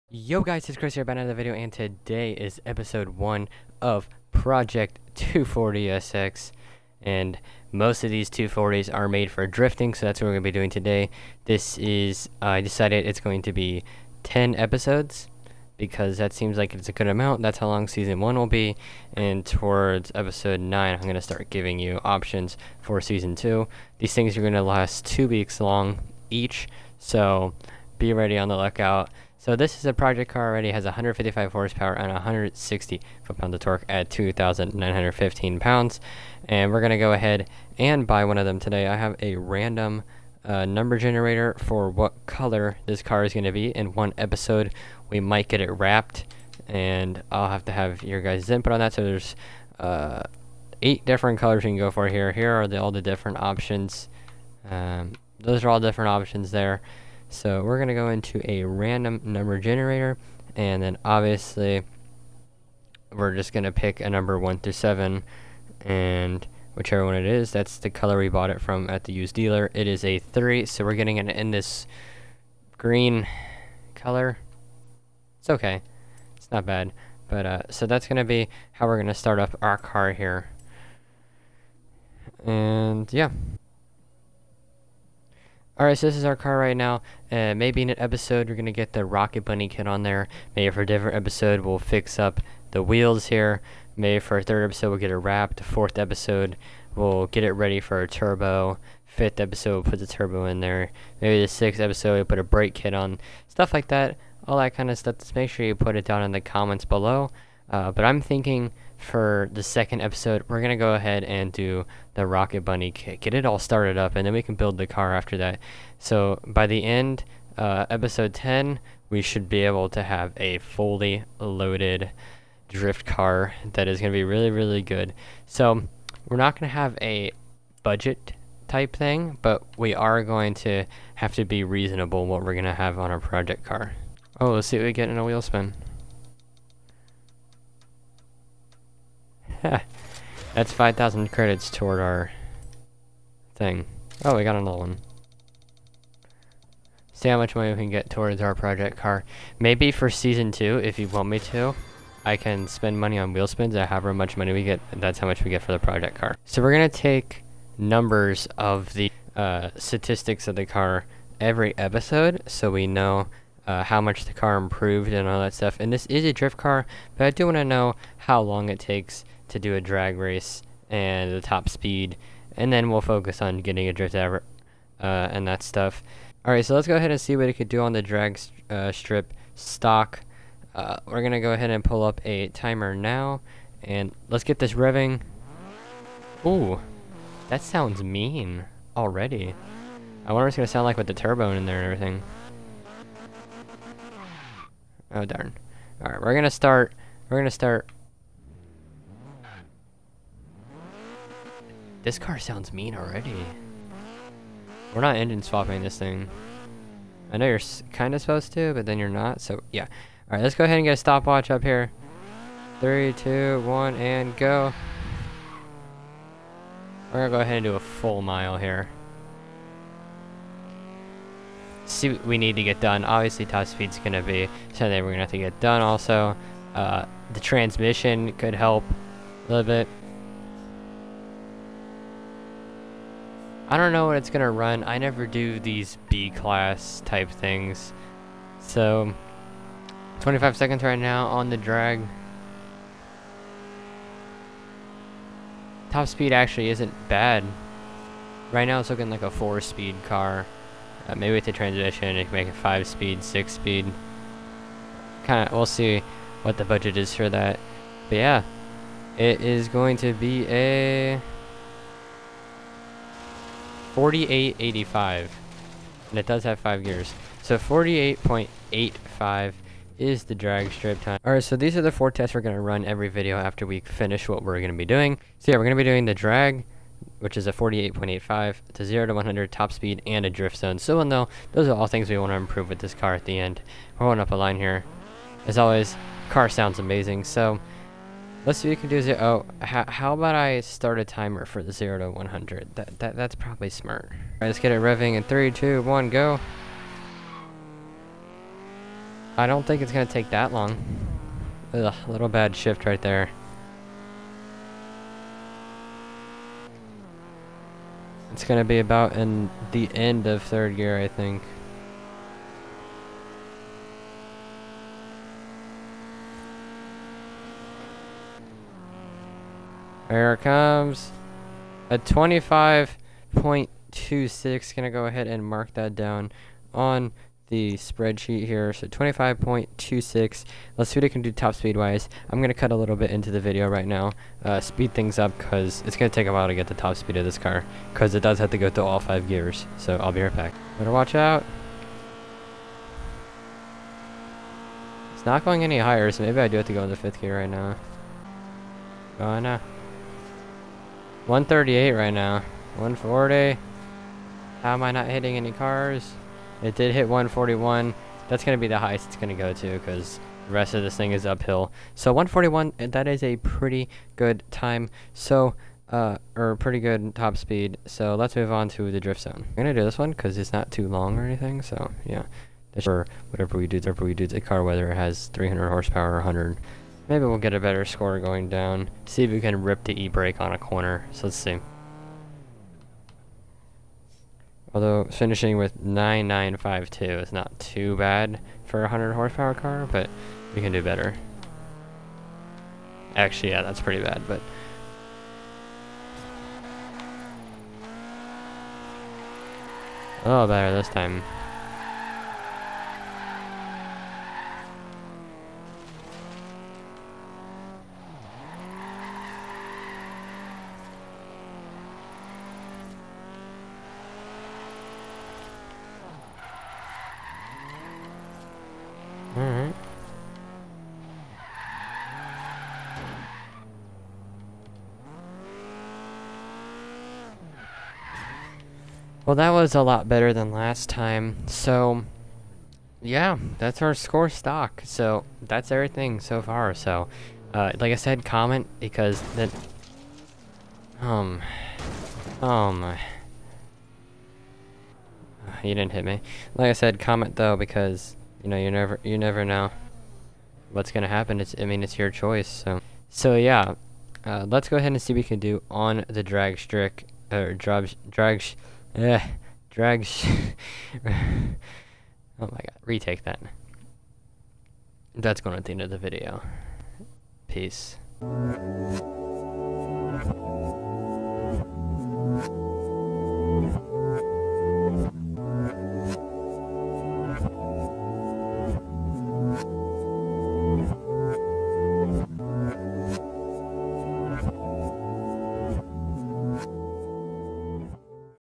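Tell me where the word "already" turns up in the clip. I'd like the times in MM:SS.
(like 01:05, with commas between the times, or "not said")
00:30, 03:08, 03:22.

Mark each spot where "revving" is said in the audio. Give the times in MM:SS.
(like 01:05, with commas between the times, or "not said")
03:04, 04:54.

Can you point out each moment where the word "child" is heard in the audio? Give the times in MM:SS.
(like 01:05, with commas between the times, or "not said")
not said.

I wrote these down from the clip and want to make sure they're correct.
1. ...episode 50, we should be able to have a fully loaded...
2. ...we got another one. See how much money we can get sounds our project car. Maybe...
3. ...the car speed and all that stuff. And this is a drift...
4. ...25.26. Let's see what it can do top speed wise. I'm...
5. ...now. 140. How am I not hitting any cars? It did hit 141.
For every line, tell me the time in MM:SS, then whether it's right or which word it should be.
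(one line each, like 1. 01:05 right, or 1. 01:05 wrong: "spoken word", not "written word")
1. 01:57 wrong: "10", not "50"
2. 02:24 wrong: "towards", not "sounds"
3. 02:44 wrong: "improved", not "speed"
4. 05:28 right
5. 05:52 right.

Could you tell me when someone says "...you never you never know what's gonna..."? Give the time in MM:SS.
07:28.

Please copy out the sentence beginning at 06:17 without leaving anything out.
Maybe we'll get a better score going down.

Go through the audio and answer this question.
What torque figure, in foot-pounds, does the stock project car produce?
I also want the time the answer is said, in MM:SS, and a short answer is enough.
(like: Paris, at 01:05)
160, at 00:32.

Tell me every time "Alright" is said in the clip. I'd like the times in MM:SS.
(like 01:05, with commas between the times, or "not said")
01:25, 02:56, 03:16, 03:30, 04:31.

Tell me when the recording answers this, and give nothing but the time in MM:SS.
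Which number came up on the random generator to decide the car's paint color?
01:09.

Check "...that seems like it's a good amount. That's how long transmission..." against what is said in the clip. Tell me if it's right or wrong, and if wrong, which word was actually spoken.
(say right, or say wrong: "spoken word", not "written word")
wrong: "season", not "transmission".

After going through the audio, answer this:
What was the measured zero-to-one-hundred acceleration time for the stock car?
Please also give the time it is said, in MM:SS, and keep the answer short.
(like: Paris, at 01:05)
25.26, at 05:21.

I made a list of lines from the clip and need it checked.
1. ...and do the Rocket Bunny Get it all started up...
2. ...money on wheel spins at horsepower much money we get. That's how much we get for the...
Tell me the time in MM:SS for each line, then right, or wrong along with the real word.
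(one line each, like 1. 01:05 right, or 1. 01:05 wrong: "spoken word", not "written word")
1. 01:51 right
2. 02:32 wrong: "however", not "horsepower".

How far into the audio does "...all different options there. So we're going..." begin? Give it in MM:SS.
00:55.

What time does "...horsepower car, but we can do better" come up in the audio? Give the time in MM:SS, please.
06:29.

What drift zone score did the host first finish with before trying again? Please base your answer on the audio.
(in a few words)
9952.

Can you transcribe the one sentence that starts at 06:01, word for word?
So 141, eh, that is a pretty good time.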